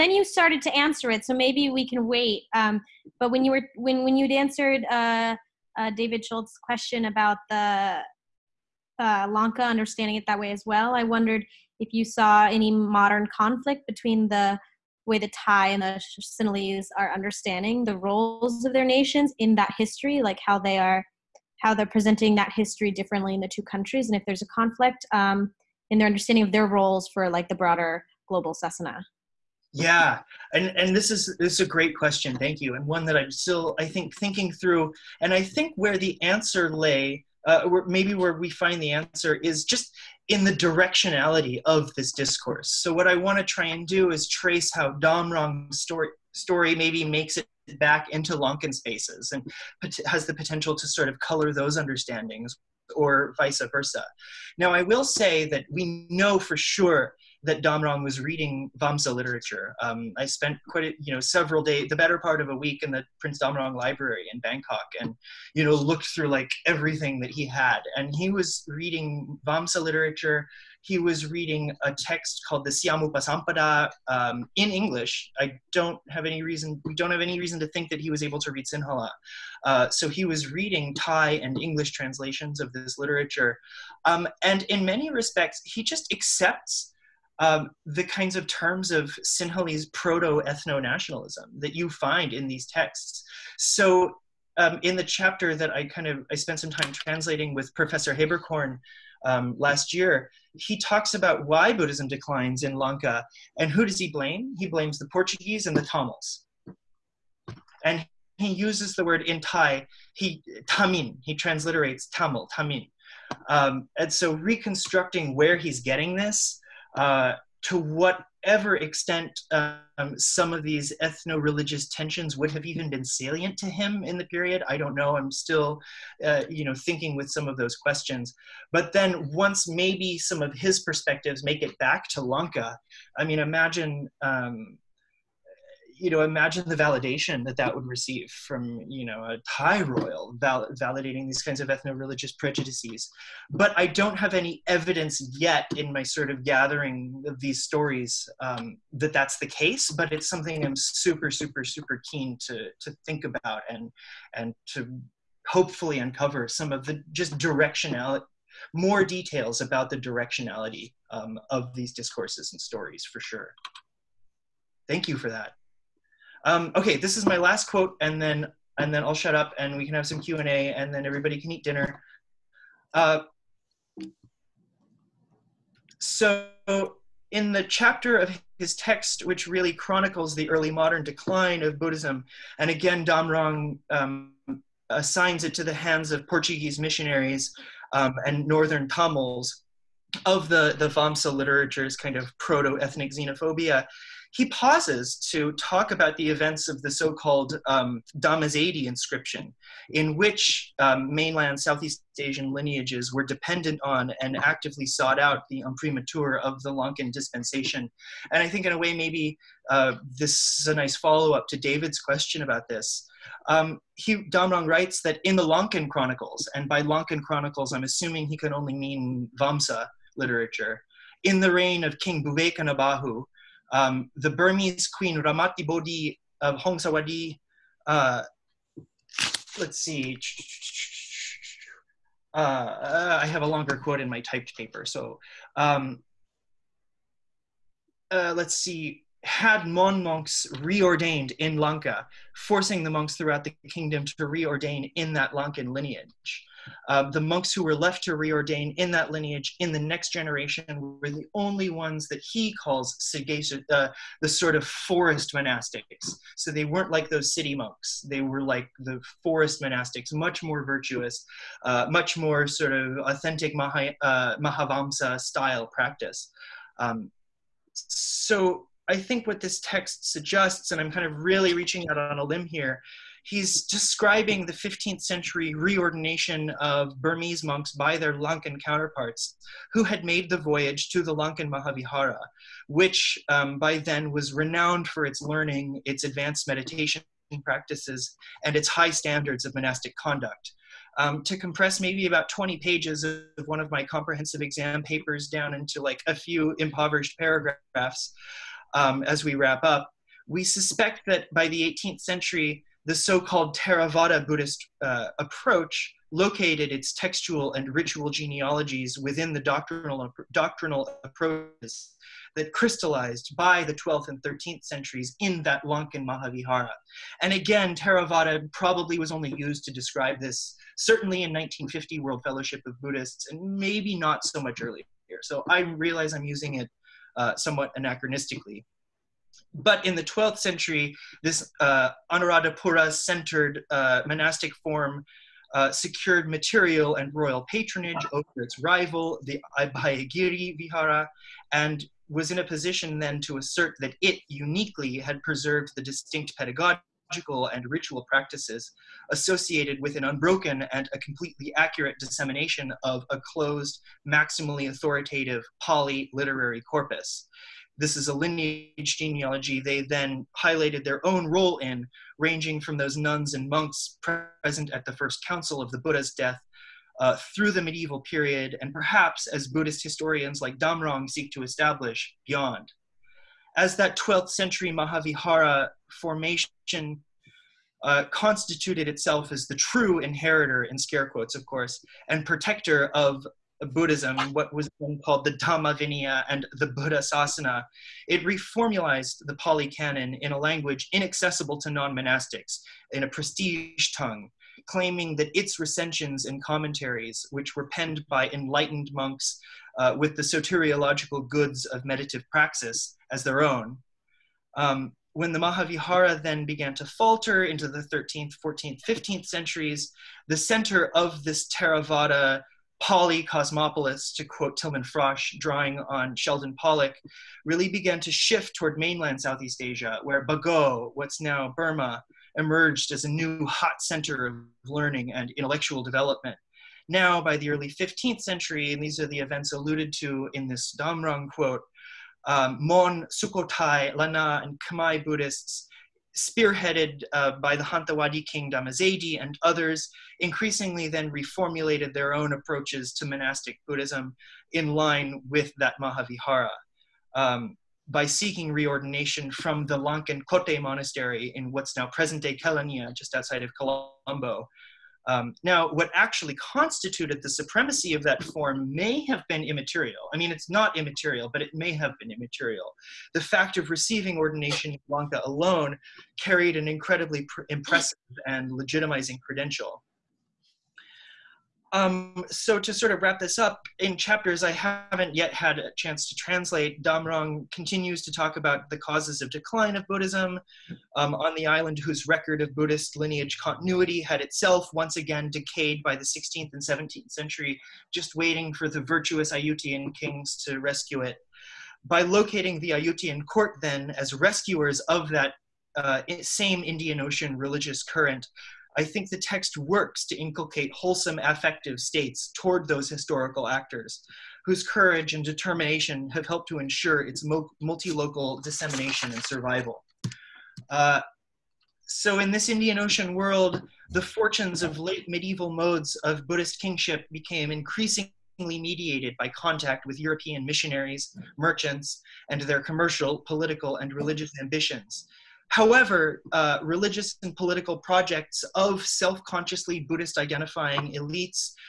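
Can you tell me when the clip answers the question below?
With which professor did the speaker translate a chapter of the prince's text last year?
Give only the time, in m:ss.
1:37.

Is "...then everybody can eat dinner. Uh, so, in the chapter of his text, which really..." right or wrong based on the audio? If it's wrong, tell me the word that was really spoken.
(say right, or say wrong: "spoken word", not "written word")
right.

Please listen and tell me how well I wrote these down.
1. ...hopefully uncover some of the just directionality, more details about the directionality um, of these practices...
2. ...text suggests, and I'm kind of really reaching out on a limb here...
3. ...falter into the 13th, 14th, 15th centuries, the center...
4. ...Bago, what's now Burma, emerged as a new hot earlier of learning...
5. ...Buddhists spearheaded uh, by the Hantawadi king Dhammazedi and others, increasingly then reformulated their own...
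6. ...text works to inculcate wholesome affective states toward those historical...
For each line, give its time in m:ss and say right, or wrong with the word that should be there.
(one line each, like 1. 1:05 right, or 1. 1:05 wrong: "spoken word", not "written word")
1. 2:35 wrong: "discourses", not "practices"
2. 4:29 right
3. 6:46 right
4. 7:00 wrong: "center", not "earlier"
5. 7:15 right
6. 8:19 right.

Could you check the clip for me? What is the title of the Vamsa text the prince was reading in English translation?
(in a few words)
Siamupasampada.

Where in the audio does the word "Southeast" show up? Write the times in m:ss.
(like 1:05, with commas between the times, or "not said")
3:21, 6:59.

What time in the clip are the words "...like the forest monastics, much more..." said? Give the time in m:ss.
4:18.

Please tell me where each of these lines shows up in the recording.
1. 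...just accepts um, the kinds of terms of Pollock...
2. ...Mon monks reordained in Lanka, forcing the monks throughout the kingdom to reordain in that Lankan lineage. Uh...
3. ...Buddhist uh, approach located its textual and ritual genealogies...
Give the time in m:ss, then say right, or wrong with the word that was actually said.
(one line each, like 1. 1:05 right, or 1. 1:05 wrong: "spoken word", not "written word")
1. 1:25 wrong: "Sinhalese", not "Pollock"
2. 3:59 right
3. 5:04 right.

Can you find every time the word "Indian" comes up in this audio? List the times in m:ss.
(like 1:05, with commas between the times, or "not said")
8:16, 8:32.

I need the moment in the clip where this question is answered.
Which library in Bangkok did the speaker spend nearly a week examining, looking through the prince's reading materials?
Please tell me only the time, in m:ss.
1:03.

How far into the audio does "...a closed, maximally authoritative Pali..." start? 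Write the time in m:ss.
5:53.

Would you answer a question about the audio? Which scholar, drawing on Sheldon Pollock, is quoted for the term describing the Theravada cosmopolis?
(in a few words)
Tilman Frasch.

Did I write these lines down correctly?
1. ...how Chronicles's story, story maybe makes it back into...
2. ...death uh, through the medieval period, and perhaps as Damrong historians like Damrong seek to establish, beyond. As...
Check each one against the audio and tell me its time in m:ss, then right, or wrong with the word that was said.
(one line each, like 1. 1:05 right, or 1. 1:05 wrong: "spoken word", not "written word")
1. 0:44 wrong: "Damrong", not "Chronicles"
2. 6:06 wrong: "Buddhist", not "Damrong".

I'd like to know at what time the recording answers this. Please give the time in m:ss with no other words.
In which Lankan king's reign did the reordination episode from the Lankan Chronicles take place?
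3:41.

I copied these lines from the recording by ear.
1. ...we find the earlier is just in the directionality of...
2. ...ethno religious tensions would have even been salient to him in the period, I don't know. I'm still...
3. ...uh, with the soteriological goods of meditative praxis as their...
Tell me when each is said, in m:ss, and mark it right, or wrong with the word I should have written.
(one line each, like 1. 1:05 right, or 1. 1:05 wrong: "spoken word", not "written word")
1. 0:38 wrong: "answer", not "earlier"
2. 2:01 right
3. 6:39 right.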